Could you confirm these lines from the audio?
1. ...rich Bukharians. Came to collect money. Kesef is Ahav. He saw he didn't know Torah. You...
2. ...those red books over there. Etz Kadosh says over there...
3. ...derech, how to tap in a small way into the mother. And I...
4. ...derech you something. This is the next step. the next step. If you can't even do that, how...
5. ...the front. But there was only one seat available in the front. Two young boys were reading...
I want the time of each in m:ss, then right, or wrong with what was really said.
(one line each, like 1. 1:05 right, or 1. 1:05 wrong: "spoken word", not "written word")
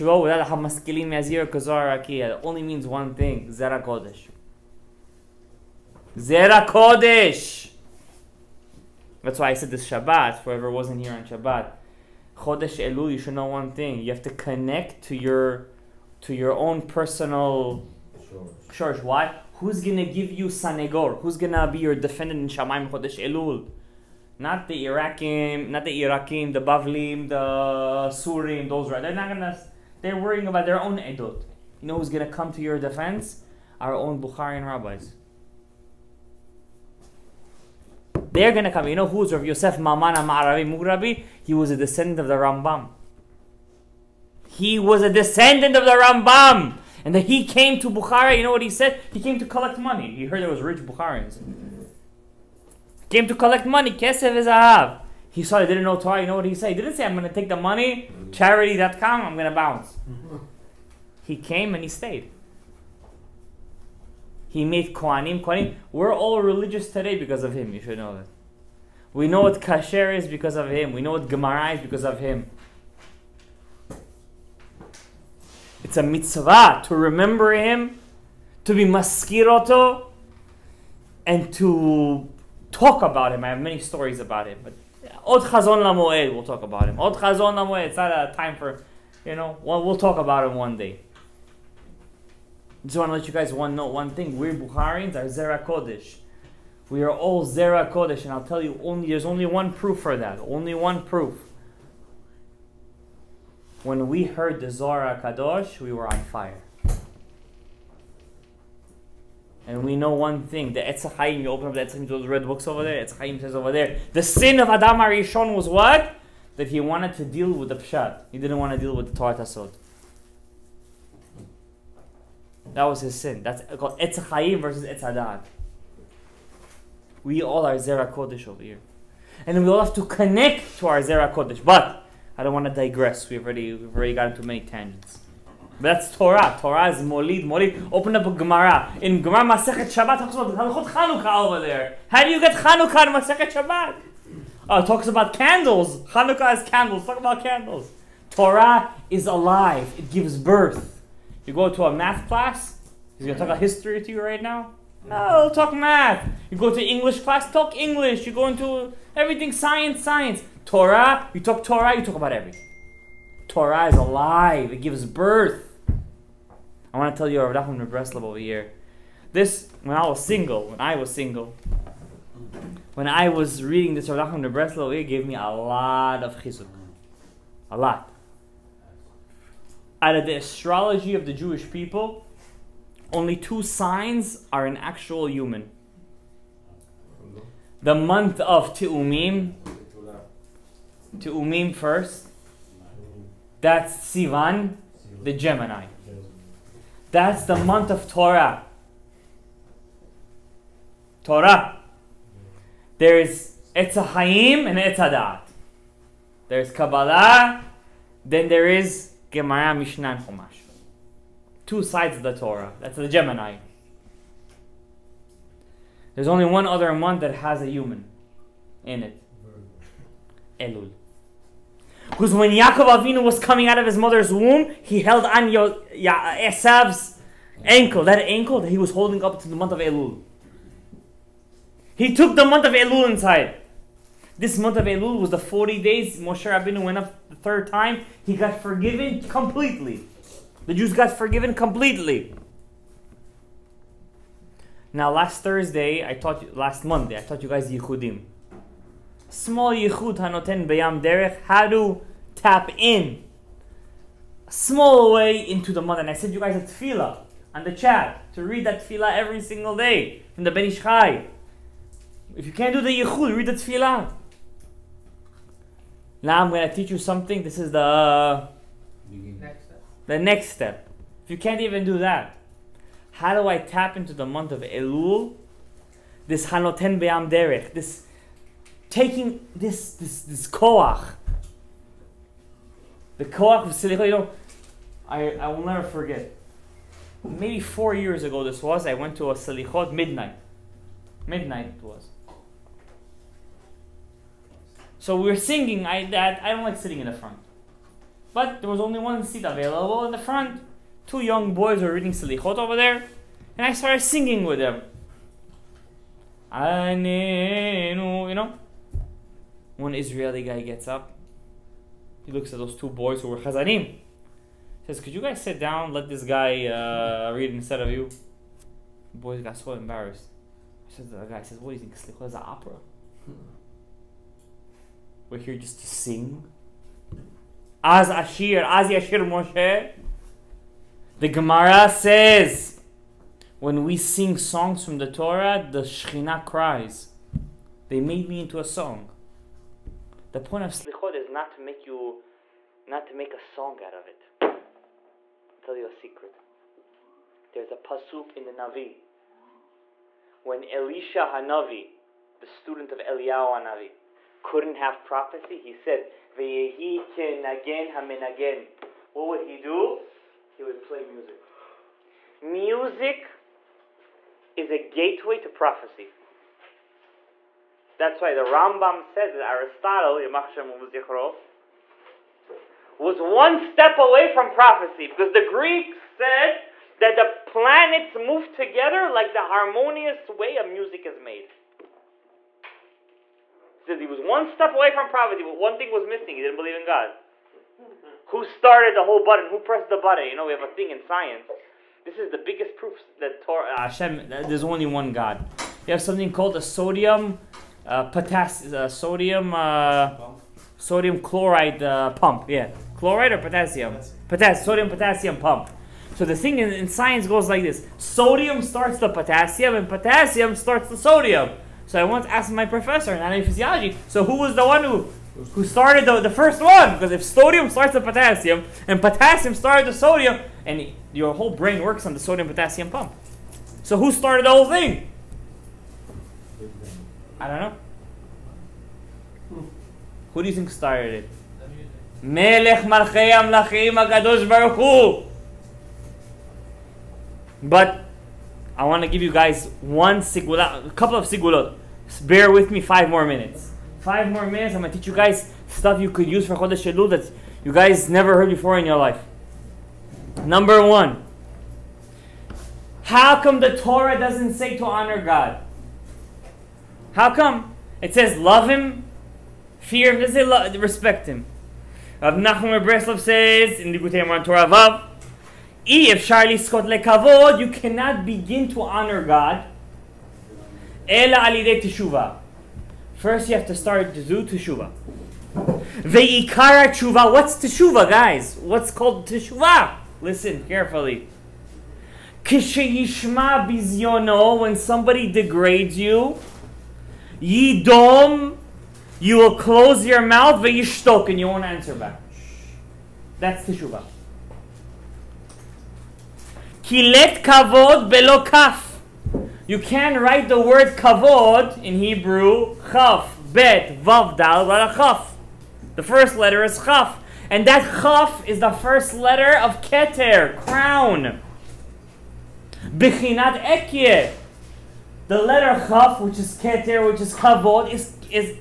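1. 0:50 right
2. 1:52 wrong: "Chaim", not "Kadosh"
3. 4:11 right
4. 4:26 wrong: "teach", not "derech"
5. 4:57 right.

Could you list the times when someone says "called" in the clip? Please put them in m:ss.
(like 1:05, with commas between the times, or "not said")
2:03, 6:36, 7:58.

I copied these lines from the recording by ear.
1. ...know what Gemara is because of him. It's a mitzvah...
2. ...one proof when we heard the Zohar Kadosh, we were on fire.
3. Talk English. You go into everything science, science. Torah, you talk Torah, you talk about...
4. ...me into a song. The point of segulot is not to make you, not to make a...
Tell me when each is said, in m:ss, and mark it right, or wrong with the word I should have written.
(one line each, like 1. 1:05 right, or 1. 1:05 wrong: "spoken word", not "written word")
1. 1:11 right
2. 1:40 right
3. 2:37 right
4. 5:38 wrong: "slichot", not "segulot".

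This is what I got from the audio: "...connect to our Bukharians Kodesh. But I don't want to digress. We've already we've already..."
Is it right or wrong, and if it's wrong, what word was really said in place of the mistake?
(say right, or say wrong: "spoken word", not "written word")
wrong: "Zera", not "Bukharians".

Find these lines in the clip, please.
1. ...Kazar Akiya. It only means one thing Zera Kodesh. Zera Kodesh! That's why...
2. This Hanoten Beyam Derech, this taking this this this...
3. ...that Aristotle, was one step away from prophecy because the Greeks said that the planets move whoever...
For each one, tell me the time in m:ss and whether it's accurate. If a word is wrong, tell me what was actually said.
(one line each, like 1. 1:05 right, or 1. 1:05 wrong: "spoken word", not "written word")
1. 0:01 right
2. 4:36 right
3. 6:09 wrong: "together", not "whoever".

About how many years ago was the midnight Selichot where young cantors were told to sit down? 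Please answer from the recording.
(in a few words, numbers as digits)
4.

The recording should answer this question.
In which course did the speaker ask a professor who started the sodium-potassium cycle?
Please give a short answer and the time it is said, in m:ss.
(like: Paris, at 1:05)
Anatomy physiology, at 6:53.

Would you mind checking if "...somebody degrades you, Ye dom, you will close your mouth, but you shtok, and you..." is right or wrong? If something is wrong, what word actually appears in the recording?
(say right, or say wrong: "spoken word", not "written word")
right.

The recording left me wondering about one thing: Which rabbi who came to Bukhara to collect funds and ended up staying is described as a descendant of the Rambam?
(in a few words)
Rav Yosef Mamana Maravi Mugrabi.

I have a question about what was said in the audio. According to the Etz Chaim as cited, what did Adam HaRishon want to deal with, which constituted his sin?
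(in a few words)
The pshat.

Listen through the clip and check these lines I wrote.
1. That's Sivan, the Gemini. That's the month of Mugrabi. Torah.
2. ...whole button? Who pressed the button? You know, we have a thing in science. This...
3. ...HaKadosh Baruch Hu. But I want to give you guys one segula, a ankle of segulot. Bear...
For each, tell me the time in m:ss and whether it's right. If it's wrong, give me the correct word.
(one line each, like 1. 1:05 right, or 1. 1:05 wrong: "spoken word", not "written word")
1. 3:13 wrong: "Torah", not "Mugrabi"
2. 6:29 right
3. 7:13 wrong: "couple", not "ankle".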